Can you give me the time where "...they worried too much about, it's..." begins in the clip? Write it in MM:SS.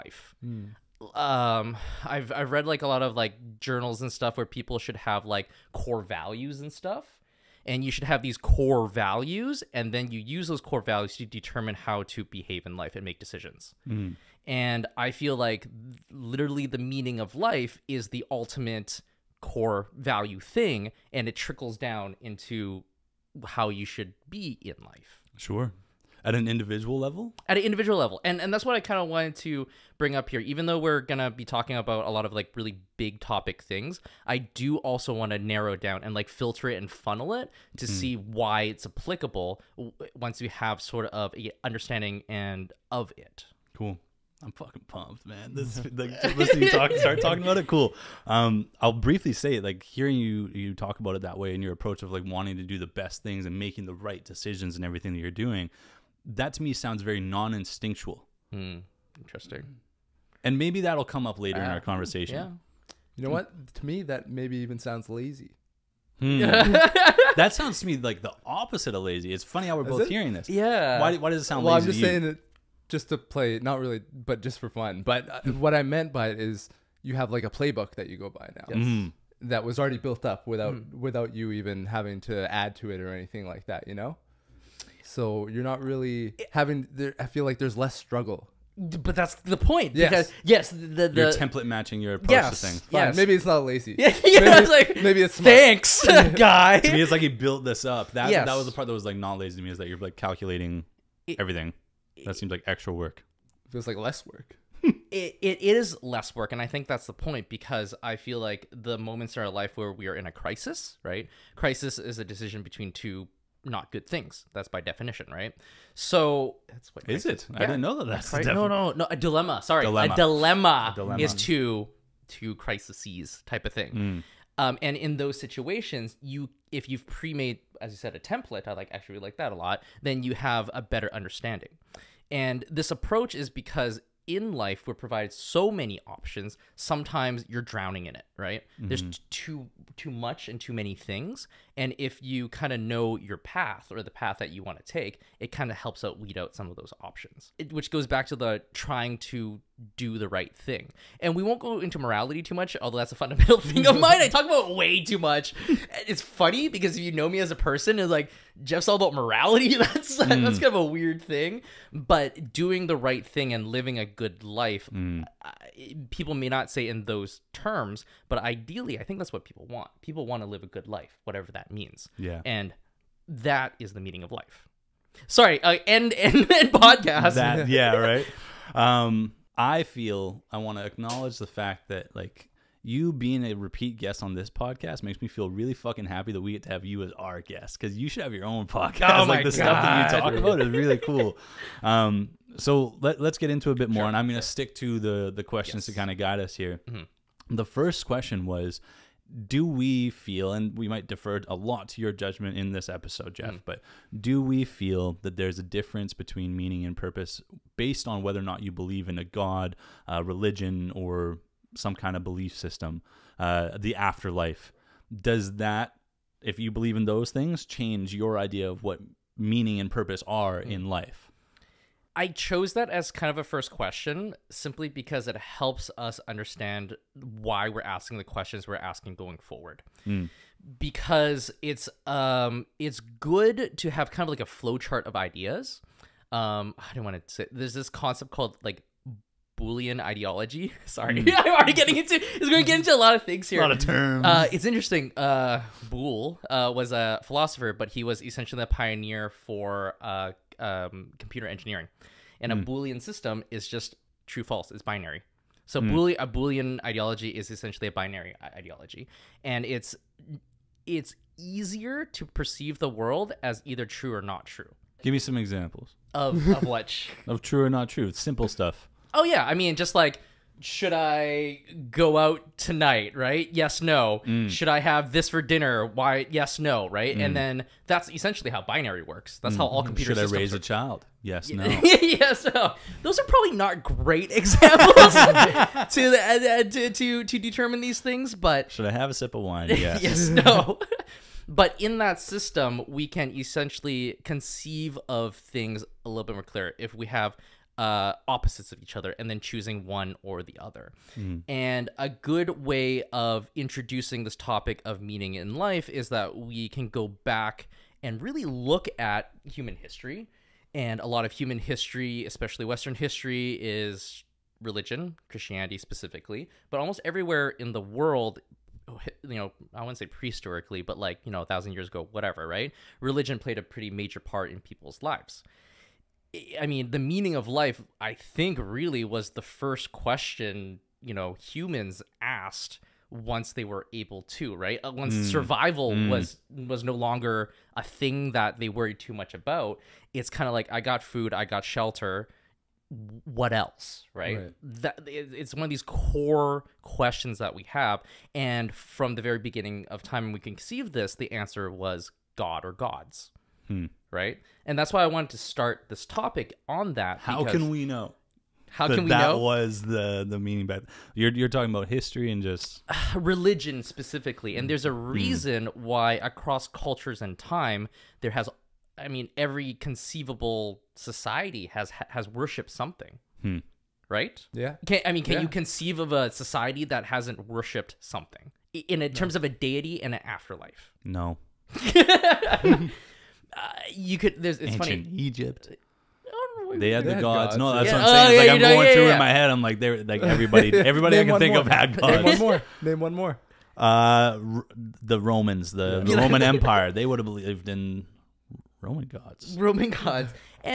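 05:38.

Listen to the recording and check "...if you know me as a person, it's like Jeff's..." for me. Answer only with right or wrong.
right.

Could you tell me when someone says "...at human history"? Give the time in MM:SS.
05:08.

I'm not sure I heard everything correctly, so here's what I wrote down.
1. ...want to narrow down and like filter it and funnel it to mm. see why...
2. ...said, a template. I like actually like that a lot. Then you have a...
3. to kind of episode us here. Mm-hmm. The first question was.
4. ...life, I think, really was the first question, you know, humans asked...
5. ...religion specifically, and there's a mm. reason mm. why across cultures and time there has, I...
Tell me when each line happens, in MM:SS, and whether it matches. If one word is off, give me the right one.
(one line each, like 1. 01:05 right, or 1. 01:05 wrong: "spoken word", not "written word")
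1. 00:35 right
2. 02:07 right
3. 03:15 wrong: "guide", not "episode"
4. 05:27 right
5. 06:03 right.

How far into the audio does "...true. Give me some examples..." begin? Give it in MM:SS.
04:24.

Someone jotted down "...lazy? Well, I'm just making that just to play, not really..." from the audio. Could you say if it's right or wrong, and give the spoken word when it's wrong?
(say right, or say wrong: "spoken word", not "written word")
wrong: "saying", not "making".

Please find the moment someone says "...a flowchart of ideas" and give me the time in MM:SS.
03:54.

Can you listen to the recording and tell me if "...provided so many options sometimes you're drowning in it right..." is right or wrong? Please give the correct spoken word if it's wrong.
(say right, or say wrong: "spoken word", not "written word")
right.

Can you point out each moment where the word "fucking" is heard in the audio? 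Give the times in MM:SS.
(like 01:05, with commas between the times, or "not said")
00:44, 03:05.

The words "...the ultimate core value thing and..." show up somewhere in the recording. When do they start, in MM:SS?
00:18.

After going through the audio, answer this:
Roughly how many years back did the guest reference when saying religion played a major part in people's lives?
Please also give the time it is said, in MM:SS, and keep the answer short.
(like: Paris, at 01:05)
1000 years, at 05:21.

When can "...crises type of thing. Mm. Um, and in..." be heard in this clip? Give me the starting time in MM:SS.
02:02.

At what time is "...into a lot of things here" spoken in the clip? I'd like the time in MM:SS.
04:02.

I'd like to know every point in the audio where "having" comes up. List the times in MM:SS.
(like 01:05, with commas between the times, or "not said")
01:21, 01:26.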